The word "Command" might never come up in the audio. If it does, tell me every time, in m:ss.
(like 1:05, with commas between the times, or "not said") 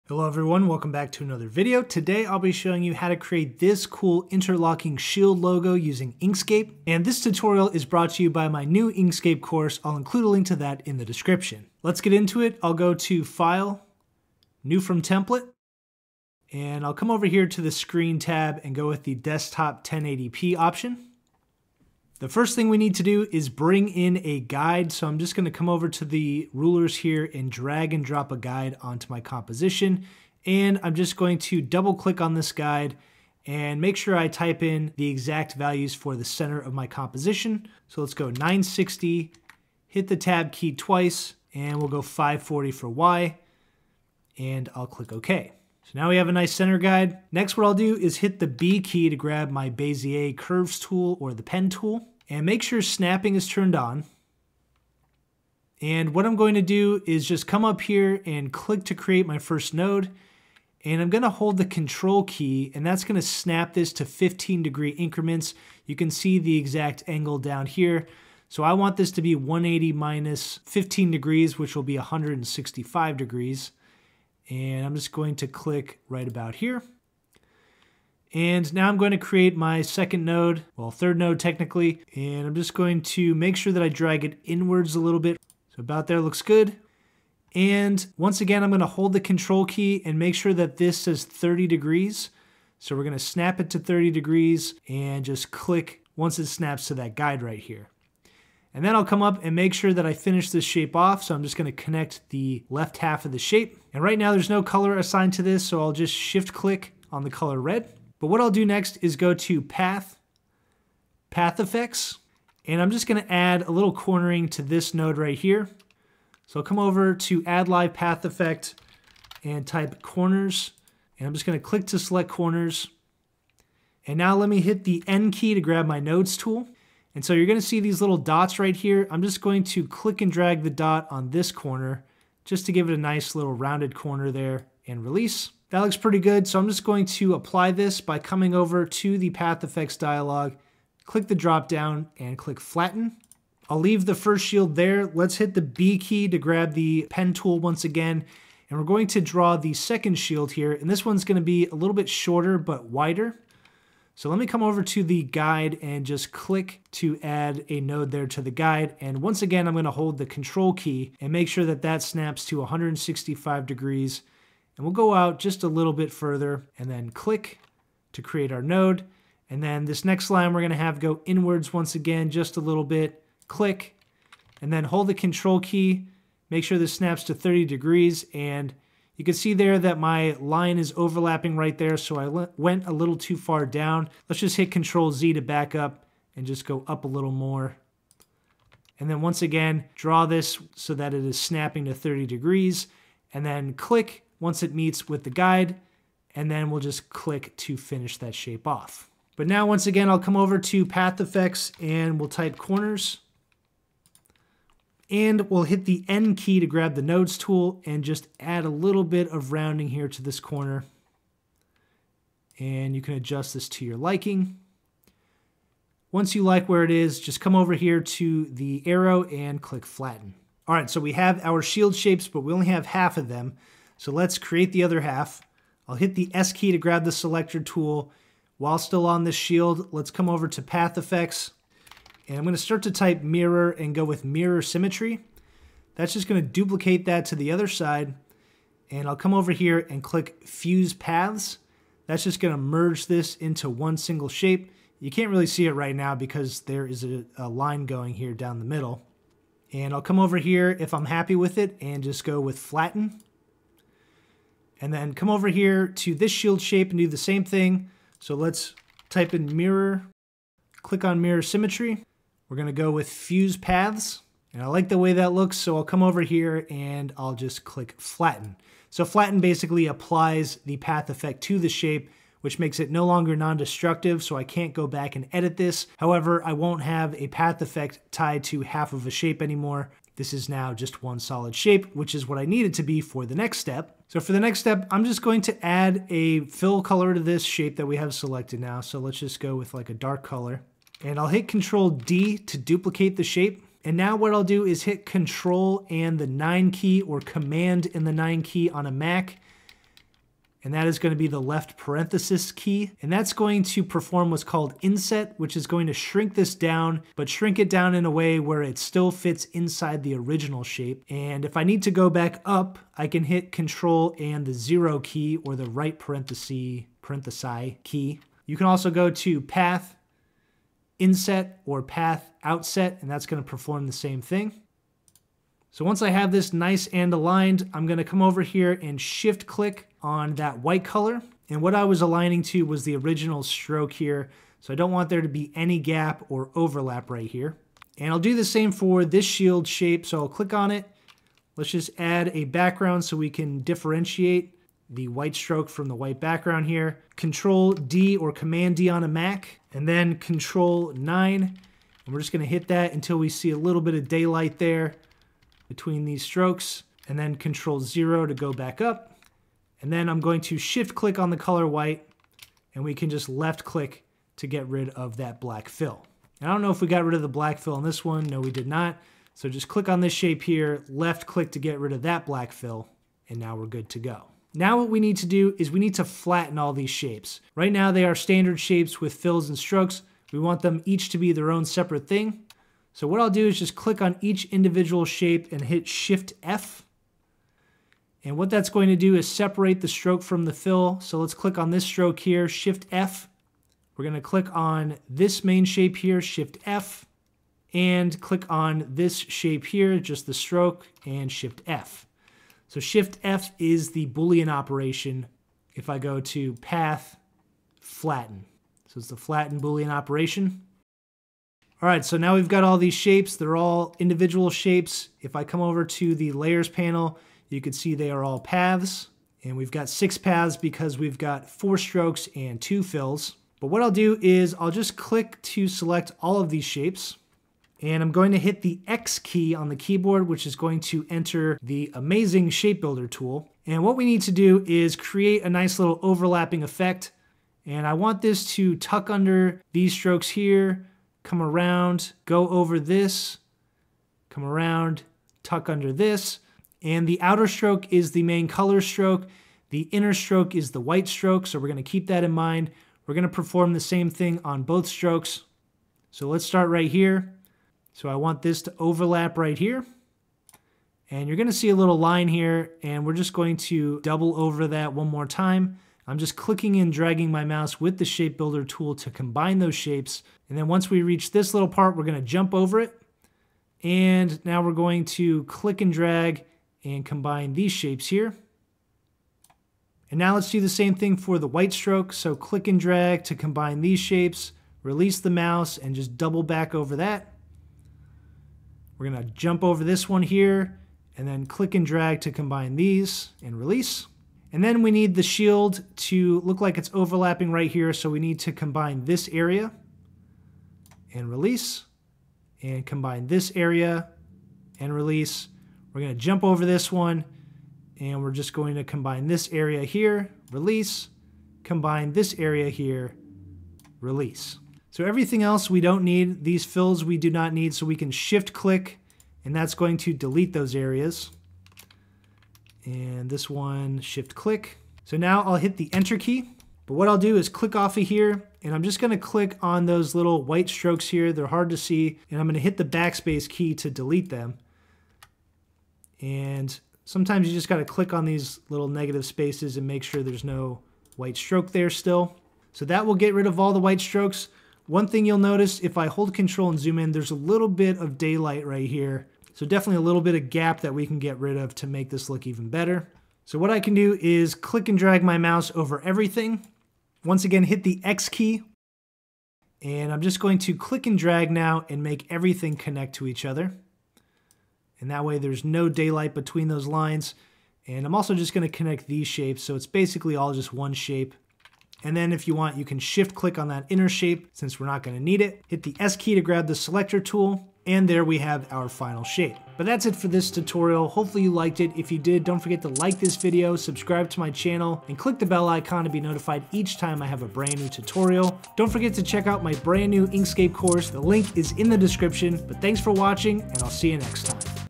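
4:57, 5:48.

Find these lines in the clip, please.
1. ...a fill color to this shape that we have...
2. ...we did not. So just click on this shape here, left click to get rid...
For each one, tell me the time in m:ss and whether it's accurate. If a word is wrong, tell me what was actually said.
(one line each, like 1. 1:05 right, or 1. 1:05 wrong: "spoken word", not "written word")
1. 4:46 right
2. 6:08 right.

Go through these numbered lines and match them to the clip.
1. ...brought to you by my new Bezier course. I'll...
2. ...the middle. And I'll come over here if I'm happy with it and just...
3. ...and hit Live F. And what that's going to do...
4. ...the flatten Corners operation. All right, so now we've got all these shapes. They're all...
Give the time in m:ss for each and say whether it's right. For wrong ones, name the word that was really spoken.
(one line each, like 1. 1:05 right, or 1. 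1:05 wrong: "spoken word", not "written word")
1. 0:07 wrong: "Inkscape", not "Bezier"
2. 4:08 right
3. 6:25 wrong: "Shift", not "Live"
4. 6:49 wrong: "Boolean", not "Corners".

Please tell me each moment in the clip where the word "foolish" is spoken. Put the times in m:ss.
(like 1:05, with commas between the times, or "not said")
not said.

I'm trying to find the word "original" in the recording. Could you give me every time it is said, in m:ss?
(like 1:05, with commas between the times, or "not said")
5:10, 5:32.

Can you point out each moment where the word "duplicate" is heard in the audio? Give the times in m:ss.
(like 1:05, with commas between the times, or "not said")
3:56, 4:52.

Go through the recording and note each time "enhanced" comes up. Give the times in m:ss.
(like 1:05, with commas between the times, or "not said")
not said.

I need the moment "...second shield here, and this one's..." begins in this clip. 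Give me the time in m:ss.
2:29.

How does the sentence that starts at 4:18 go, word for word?
So let's type in mirror, click on mirror symmetry.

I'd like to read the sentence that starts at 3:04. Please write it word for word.
Let's just hit control Z to back up and just go up a little more.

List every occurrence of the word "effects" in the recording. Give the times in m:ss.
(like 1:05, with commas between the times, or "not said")
1:51, 1:58, 2:19, 3:21, 3:50, 4:31, 4:37, 7:16.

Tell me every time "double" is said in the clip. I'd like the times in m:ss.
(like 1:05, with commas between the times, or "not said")
0:31, 7:44, 8:06.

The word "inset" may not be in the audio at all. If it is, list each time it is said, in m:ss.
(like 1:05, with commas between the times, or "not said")
5:04, 5:20.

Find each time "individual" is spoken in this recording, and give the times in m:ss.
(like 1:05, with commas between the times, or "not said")
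6:24, 6:53.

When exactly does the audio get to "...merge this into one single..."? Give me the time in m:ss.
4:02.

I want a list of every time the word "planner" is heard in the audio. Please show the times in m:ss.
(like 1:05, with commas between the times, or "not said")
not said.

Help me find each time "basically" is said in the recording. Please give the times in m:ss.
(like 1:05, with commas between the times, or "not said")
4:29, 9:29.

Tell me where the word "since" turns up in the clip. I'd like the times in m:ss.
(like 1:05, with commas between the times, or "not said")
9:34.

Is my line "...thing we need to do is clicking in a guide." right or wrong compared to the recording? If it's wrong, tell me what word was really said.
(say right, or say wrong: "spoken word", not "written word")
wrong: "bring", not "clicking".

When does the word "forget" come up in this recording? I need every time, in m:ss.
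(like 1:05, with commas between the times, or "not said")
9:42, 9:48.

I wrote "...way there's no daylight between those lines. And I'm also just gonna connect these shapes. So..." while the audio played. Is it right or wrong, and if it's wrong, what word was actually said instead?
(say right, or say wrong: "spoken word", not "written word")
right.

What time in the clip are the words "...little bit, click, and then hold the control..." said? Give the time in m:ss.
2:52.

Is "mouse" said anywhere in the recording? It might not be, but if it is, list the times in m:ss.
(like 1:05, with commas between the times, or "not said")
7:47, 8:05, 9:15.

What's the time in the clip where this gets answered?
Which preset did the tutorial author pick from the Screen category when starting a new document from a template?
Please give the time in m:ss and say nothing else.
0:19.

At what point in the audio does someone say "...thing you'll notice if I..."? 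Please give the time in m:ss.
9:05.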